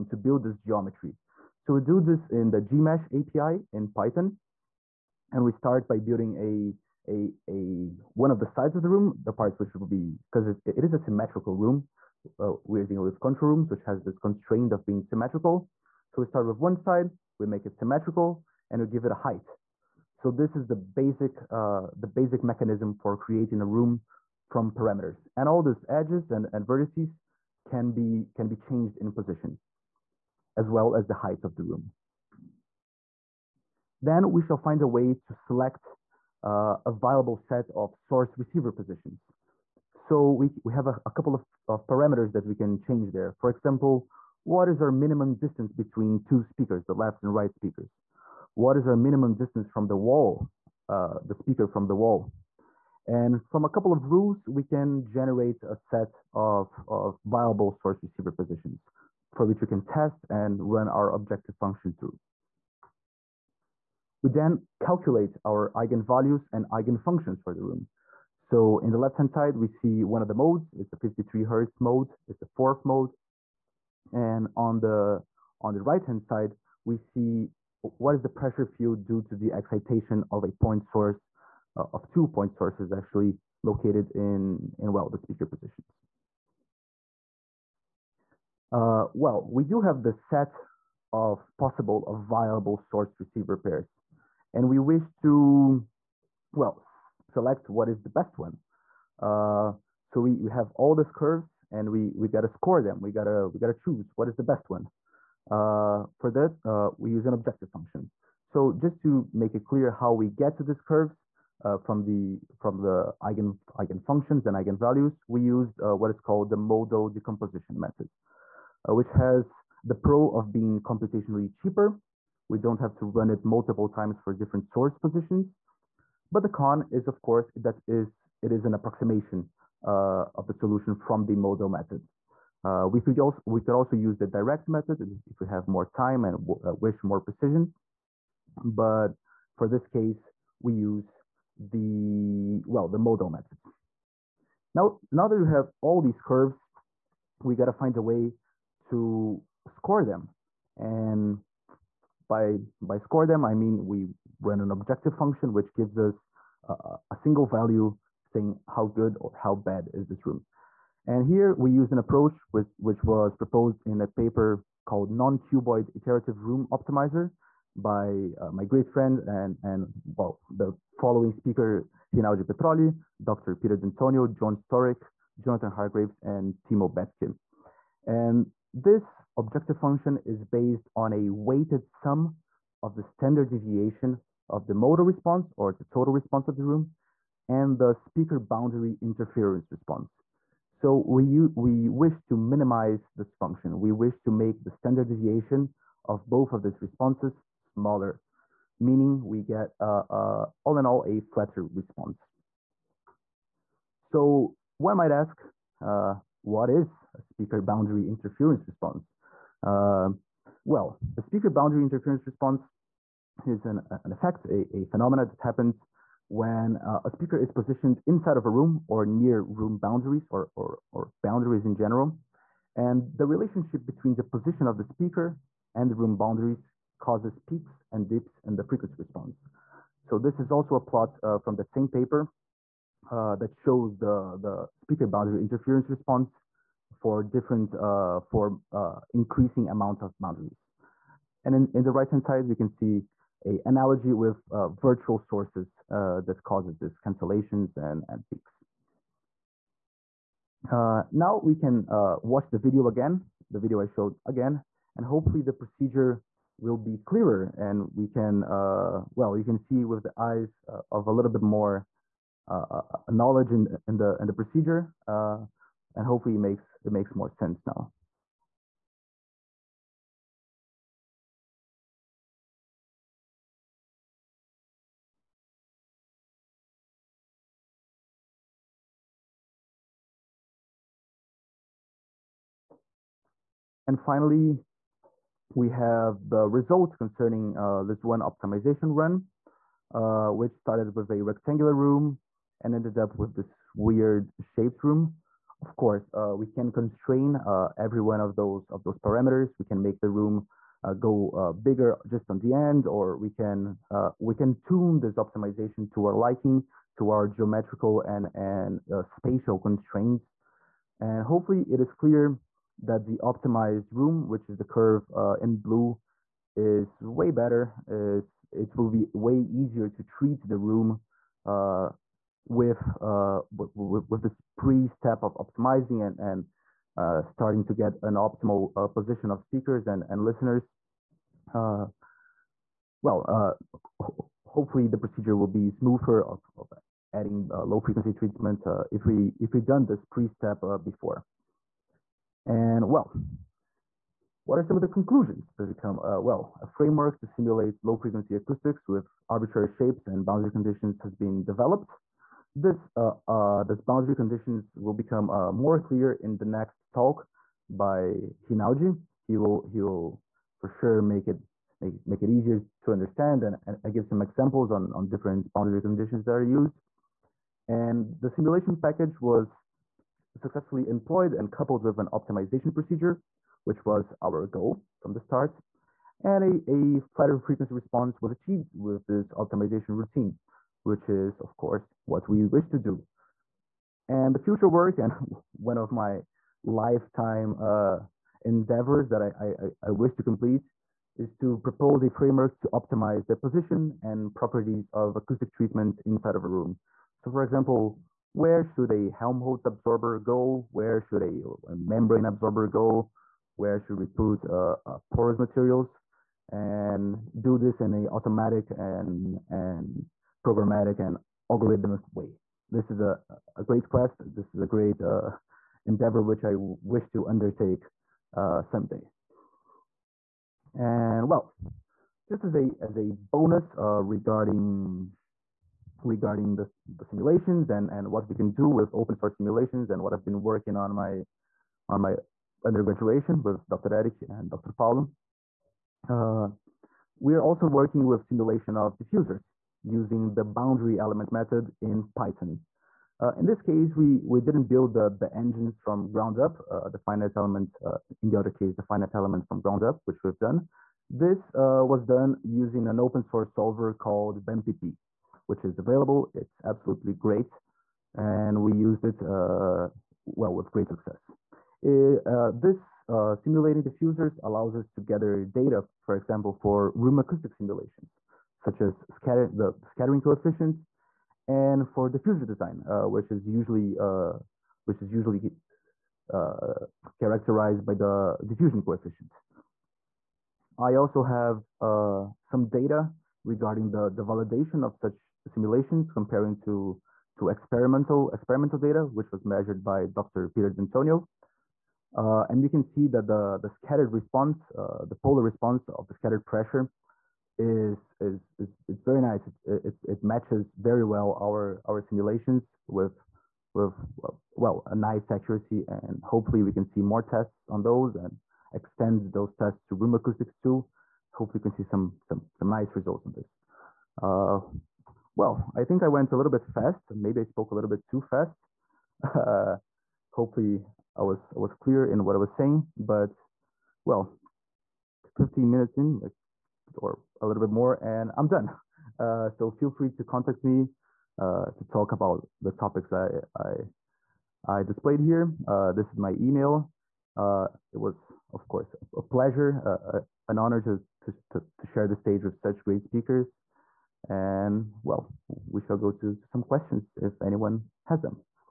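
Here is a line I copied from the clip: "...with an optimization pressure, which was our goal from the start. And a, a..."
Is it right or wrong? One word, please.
wrong.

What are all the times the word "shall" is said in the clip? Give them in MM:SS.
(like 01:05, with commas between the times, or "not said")
00:34, 09:05.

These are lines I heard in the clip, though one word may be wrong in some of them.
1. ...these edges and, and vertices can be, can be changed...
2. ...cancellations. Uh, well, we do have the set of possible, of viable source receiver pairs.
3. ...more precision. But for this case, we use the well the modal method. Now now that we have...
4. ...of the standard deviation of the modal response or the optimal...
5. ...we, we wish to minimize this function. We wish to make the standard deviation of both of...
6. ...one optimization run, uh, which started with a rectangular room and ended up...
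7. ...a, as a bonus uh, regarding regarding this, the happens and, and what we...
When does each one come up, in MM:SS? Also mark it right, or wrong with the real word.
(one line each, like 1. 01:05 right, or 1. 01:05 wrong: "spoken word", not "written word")
1. 00:25 right
2. 01:25 wrong: "positions", not "cancellations"
3. 02:17 right
4. 03:02 wrong: "total", not "optimal"
5. 03:11 right
6. 04:48 right
7. 07:02 wrong: "simulations", not "happens".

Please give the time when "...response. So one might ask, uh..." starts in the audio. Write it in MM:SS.
03:21.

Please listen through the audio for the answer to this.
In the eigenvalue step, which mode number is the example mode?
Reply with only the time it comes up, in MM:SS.
01:12.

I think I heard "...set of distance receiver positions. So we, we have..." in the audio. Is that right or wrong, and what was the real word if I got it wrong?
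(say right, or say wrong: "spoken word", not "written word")
wrong: "source", not "distance".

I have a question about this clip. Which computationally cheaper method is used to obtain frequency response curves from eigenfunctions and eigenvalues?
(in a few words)
Modal decomposition method.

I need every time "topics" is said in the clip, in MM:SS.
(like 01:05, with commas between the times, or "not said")
08:52.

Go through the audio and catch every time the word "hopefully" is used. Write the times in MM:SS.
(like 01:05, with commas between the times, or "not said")
04:15, 04:26, 05:11, 05:34, 08:26, 08:31, 08:40.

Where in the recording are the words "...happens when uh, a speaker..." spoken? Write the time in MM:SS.
03:35.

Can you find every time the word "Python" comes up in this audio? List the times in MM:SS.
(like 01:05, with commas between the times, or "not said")
00:03, 07:22.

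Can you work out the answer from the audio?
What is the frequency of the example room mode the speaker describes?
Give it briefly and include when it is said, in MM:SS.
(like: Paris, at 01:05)
53 Hz, at 01:10.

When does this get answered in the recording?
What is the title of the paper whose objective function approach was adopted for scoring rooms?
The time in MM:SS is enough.
02:45.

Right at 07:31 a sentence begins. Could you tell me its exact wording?
This uh, was done using an open source solver called BEMPP which is available.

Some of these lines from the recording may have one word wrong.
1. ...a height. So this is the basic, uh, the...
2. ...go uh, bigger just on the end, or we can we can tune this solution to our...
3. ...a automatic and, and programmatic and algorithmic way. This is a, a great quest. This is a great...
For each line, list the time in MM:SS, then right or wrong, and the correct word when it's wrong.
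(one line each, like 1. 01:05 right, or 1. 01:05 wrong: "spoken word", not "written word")
1. 00:19 right
2. 05:00 wrong: "optimization", not "solution"
3. 06:47 right.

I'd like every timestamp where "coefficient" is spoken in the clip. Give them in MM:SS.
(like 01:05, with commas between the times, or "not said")
07:50, 07:58.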